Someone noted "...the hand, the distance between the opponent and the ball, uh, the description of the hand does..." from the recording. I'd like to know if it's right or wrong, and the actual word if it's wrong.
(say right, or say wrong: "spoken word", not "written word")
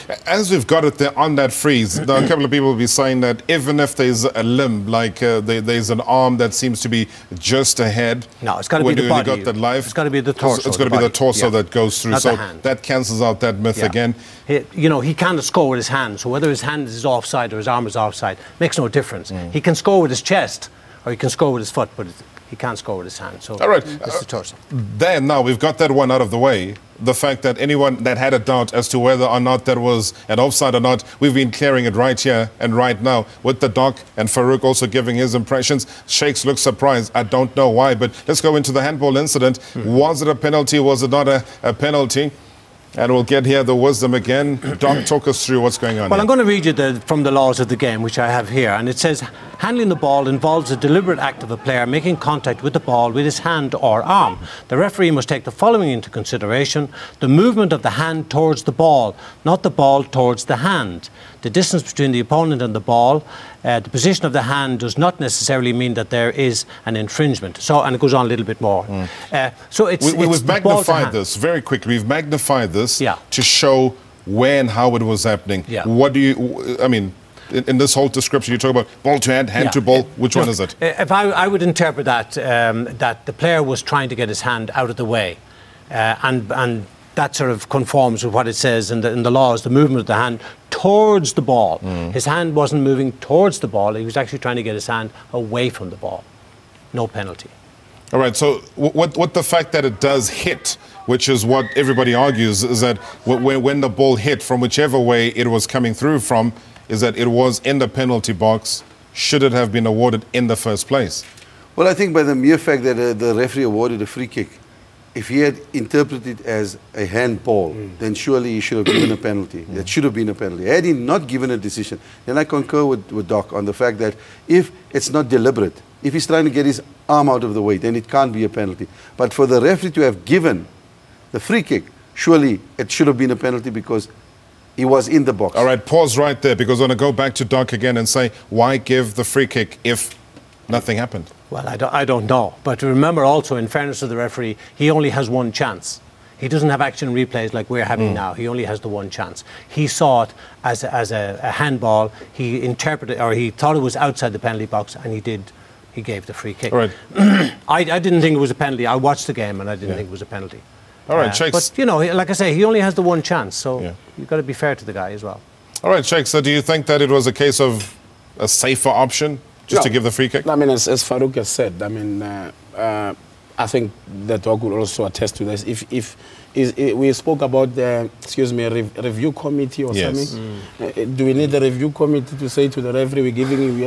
wrong: "position", not "description".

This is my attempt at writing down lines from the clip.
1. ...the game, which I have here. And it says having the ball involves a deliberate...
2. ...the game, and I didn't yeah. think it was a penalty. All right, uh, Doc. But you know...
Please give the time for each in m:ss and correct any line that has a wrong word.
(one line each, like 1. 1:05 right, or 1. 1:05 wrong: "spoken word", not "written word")
1. 0:47 wrong: "handling", not "having"
2. 2:39 wrong: "Shakes", not "Doc".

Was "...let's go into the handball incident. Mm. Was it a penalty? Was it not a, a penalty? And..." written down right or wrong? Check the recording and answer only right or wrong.
right.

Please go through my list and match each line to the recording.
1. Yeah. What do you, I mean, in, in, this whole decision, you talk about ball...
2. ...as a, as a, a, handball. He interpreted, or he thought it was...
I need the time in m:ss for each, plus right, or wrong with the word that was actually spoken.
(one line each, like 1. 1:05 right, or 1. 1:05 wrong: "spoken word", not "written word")
1. 1:15 wrong: "description", not "decision"
2. 2:30 right.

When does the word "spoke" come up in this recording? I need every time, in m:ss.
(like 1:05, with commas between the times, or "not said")
2:57.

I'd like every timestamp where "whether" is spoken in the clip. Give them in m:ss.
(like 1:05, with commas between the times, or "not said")
0:16, 0:28.